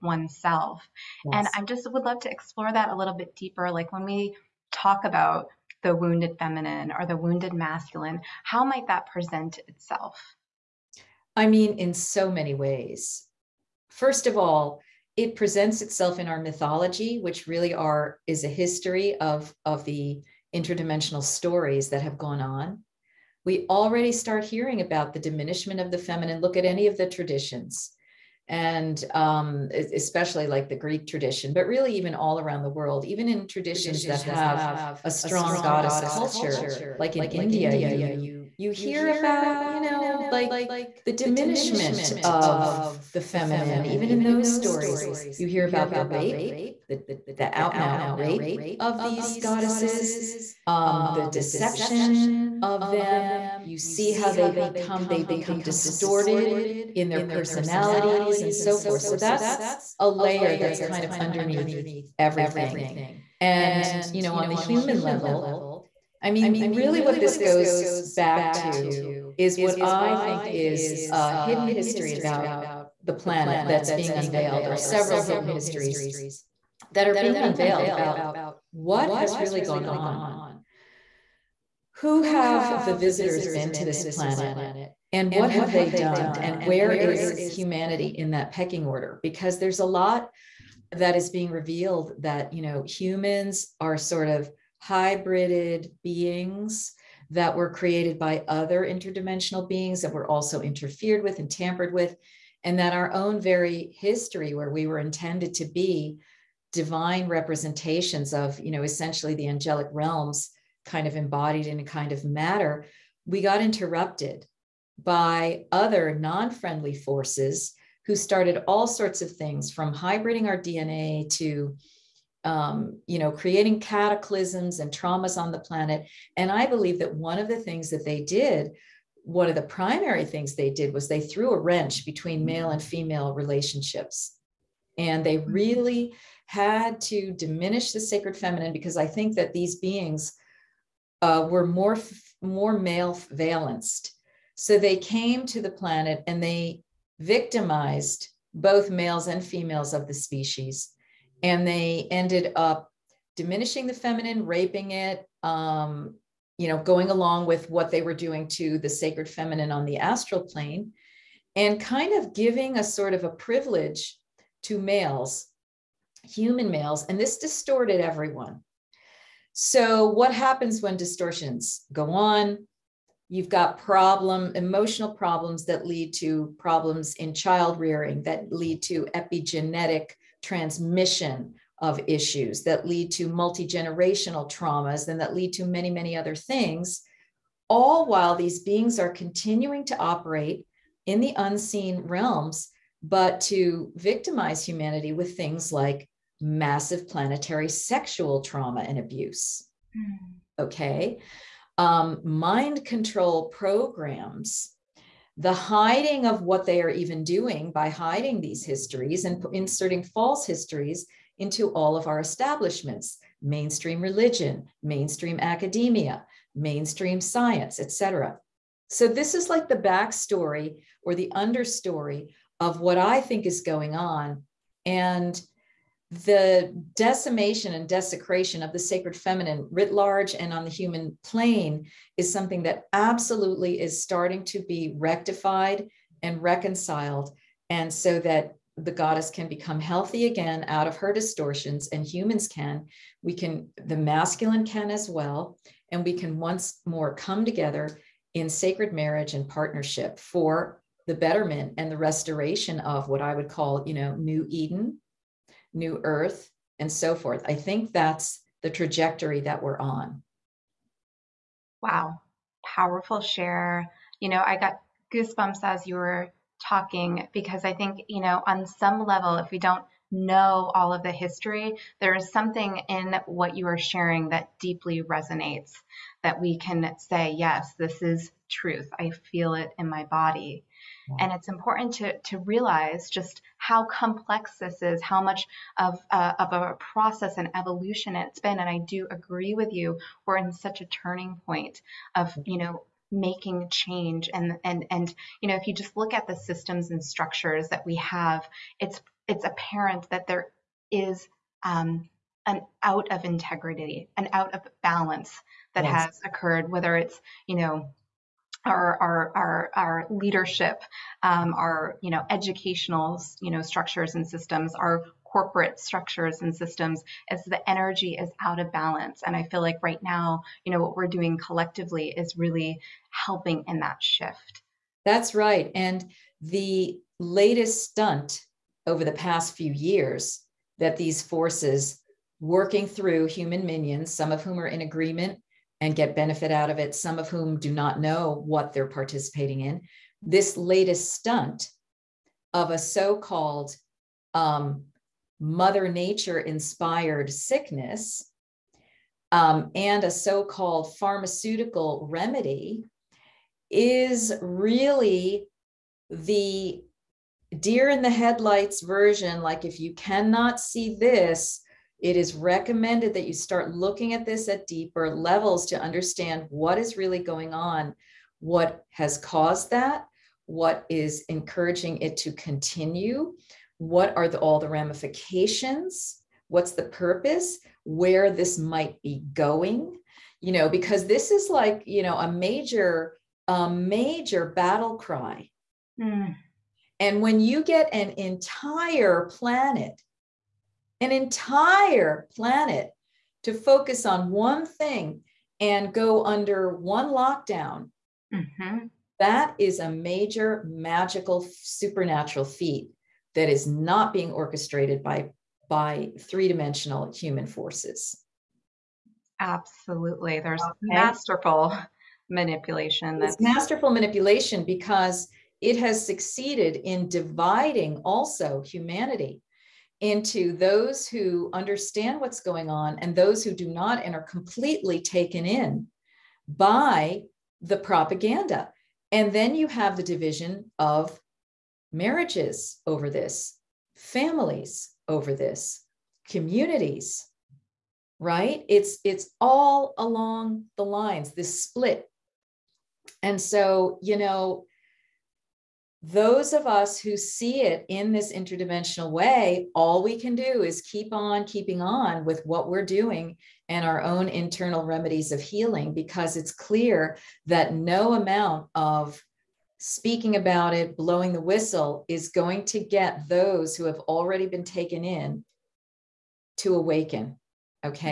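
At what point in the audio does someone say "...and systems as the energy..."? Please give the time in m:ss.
5:16.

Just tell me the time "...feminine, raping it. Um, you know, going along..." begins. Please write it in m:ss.
2:33.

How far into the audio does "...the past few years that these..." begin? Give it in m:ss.
5:29.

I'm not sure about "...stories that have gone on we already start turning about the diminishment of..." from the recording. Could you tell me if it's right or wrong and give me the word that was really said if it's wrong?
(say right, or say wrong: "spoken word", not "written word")
wrong: "hearing", not "turning".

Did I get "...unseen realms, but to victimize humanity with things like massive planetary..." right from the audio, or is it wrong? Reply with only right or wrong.
right.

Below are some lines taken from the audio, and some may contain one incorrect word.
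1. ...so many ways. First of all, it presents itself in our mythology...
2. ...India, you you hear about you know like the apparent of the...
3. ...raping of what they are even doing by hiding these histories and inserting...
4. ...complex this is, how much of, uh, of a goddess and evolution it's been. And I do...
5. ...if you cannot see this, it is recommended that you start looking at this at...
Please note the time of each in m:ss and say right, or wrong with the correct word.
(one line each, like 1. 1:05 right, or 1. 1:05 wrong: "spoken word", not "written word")
1. 0:11 right
2. 0:37 wrong: "diminishment", not "apparent"
3. 3:25 wrong: "hiding", not "raping"
4. 4:43 wrong: "process", not "goddess"
5. 5:59 right.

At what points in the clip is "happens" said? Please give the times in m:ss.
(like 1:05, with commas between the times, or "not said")
2:50.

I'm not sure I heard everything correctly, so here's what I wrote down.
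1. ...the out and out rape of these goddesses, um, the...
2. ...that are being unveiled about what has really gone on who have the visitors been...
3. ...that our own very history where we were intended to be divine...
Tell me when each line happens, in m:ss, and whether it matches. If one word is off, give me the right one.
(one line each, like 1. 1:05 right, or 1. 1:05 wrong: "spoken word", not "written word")
1. 0:47 right
2. 1:16 right
3. 1:42 right.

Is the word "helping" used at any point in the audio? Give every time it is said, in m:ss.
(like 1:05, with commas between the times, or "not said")
5:23.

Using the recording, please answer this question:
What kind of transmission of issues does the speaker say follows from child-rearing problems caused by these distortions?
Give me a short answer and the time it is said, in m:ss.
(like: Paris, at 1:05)
epigenetic, at 2:59.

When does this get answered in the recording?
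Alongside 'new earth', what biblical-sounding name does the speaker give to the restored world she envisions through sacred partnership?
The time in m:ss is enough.
4:14.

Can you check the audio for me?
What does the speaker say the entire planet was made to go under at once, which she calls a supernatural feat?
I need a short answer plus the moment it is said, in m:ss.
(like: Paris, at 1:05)
lockdown, at 6:37.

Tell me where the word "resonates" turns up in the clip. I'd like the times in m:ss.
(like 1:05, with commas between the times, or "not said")
4:35.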